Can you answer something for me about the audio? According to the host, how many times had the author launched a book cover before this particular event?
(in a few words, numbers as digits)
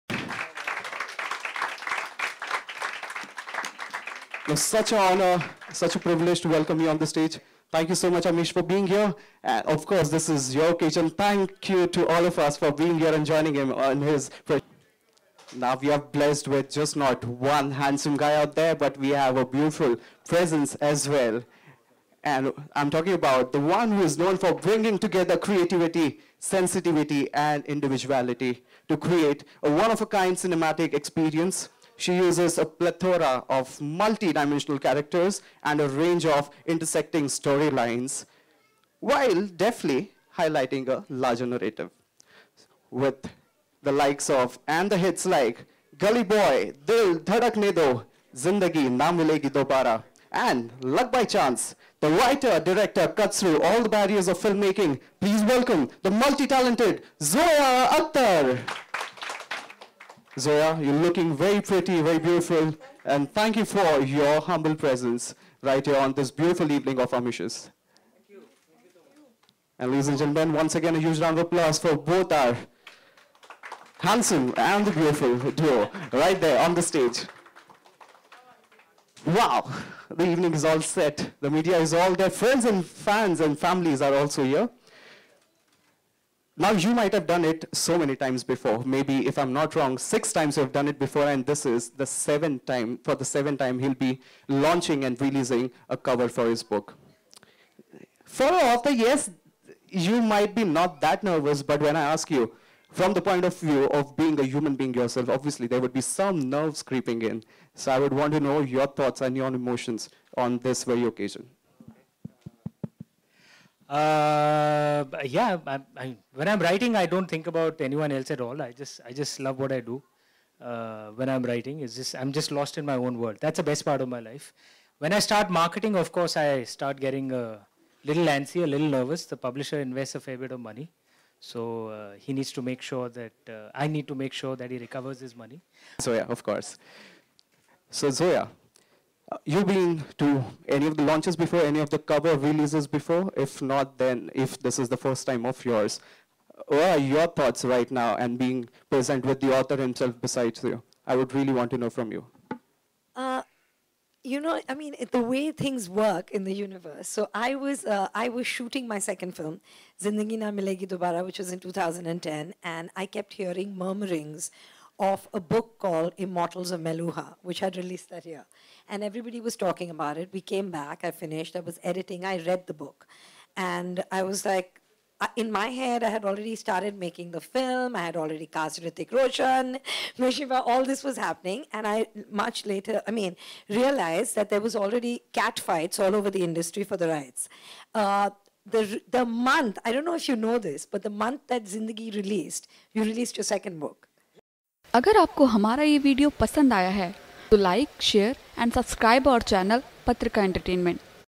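6.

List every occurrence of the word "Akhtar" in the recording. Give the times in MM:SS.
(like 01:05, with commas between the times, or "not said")
00:57.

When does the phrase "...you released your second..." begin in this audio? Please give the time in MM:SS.
03:12.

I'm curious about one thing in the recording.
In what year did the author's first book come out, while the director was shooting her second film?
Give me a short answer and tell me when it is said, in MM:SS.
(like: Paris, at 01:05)
2010, at 02:41.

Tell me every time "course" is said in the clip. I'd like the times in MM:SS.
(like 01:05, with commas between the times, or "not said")
00:09, 02:06, 02:16.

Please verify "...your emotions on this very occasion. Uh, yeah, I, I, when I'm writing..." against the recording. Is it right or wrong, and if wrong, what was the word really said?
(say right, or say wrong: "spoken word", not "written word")
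right.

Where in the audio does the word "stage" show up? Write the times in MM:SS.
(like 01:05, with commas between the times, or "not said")
00:07, 01:16.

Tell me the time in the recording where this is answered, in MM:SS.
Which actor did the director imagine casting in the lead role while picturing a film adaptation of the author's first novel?
02:58.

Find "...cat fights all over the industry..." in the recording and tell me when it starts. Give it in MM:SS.
03:05.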